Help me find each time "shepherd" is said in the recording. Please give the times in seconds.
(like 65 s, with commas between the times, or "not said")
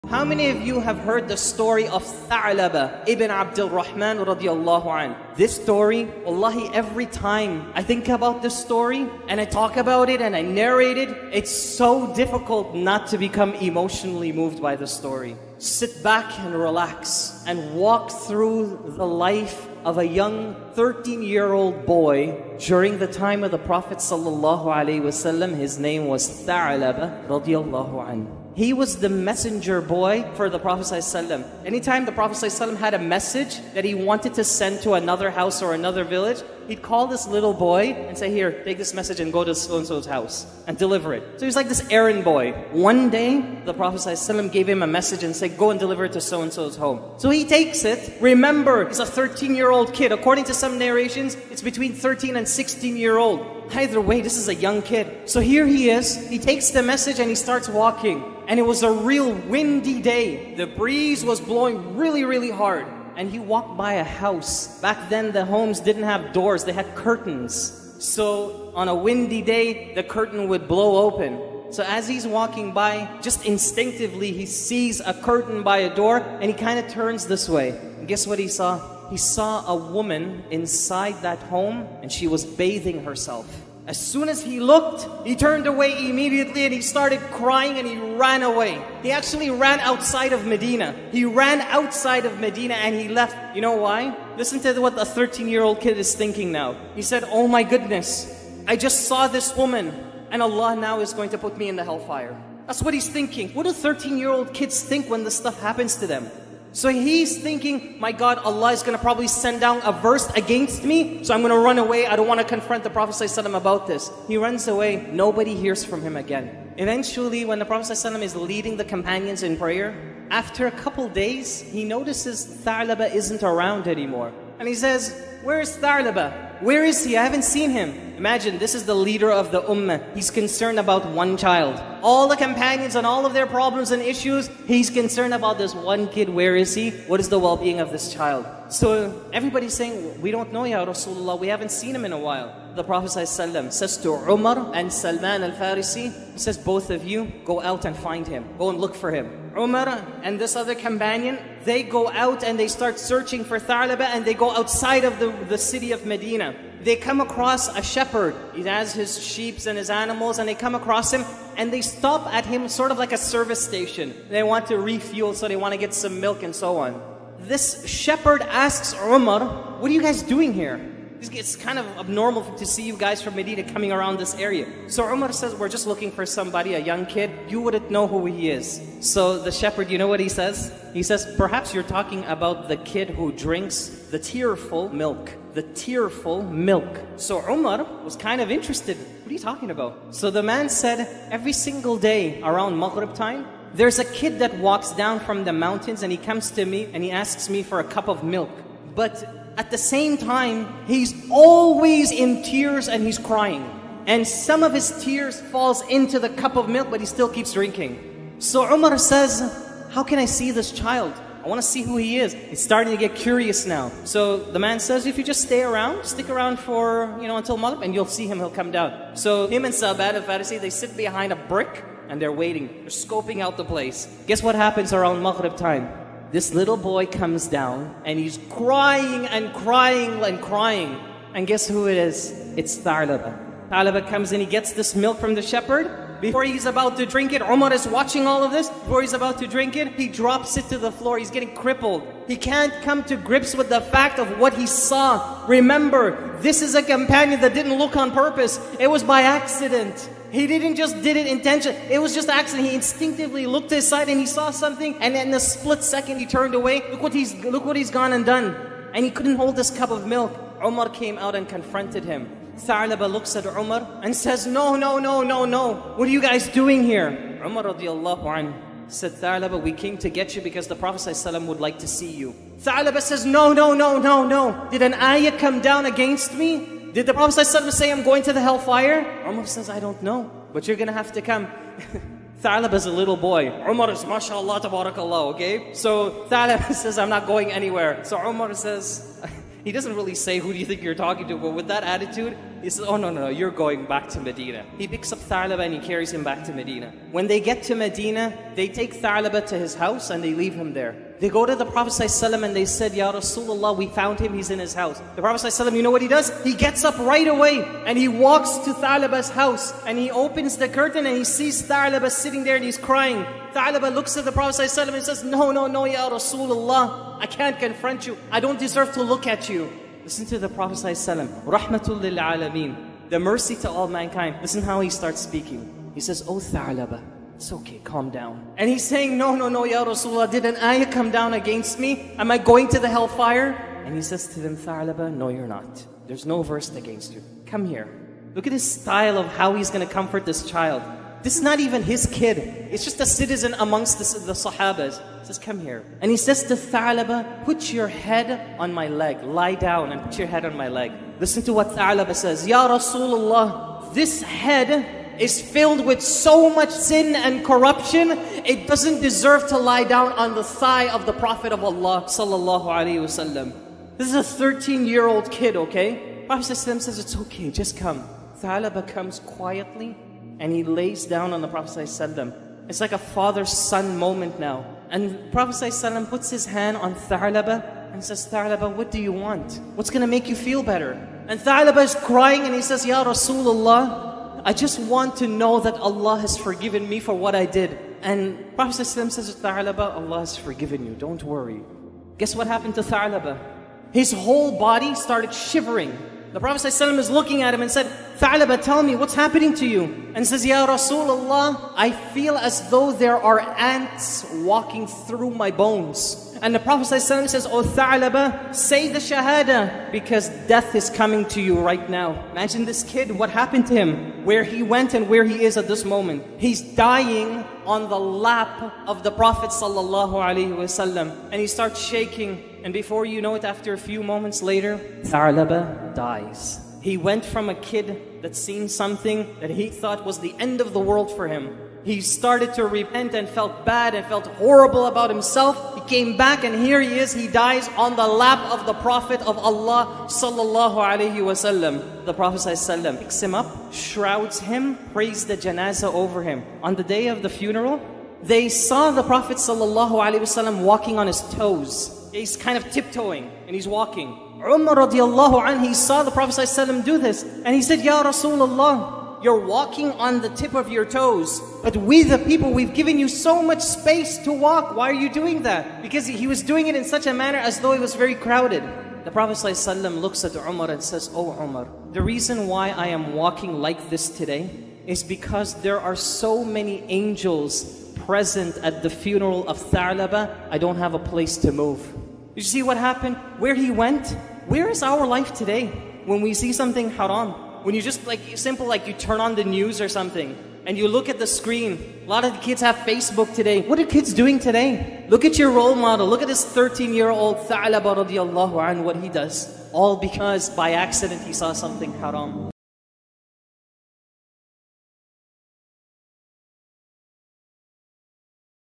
157 s, 167 s, 179 s, 235 s.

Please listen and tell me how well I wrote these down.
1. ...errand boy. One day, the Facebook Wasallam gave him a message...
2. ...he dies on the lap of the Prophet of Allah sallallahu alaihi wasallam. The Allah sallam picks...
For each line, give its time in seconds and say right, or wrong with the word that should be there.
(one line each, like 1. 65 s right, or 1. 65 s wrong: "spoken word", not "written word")
1. 41 s wrong: "Prophet", not "Facebook"
2. 437 s wrong: "Prophet", not "Allah".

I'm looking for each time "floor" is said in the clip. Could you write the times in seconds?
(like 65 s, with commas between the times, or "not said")
240 s.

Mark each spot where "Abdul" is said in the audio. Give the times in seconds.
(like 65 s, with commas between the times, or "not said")
3 s.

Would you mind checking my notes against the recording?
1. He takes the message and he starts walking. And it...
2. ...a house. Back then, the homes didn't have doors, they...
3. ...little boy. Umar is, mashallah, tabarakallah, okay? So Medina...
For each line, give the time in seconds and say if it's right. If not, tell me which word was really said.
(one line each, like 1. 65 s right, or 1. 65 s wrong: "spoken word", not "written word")
1. 56 s right
2. 63 s right
3. 282 s wrong: "Thalib", not "Medina".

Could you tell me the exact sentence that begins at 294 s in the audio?
He picks up Thalaba and he carries him back to Medina.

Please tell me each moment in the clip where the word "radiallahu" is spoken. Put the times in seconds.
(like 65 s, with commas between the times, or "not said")
4 s, 27 s, 267 s, 454 s, 498 s.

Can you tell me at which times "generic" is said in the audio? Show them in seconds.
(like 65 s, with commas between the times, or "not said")
not said.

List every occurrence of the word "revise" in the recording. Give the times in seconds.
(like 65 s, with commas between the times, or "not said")
not said.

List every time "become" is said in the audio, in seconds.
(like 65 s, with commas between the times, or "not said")
13 s.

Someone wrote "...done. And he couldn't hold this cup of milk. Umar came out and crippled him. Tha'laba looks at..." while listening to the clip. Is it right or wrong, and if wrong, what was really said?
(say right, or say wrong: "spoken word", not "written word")
wrong: "confronted", not "crippled".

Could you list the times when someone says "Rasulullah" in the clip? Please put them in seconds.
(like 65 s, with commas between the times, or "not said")
140 s, 303 s, 316 s, 329 s, 352 s, 383 s, 400 s, 458 s.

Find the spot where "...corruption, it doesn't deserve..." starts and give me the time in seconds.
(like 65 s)
357 s.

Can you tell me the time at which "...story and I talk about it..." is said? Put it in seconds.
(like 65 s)
8 s.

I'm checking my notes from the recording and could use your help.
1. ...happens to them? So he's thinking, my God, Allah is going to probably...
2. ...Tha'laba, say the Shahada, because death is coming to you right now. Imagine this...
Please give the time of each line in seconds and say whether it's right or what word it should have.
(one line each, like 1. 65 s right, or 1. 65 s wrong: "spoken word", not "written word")
1. 105 s right
2. 407 s right.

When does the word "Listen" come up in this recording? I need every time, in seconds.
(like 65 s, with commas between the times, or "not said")
94 s, 320 s, 324 s, 351 s.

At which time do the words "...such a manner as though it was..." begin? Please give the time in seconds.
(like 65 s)
466 s.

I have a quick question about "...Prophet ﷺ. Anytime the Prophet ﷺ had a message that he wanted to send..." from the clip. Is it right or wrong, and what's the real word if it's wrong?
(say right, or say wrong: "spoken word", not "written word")
right.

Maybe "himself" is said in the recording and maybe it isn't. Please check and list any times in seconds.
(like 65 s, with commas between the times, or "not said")
435 s.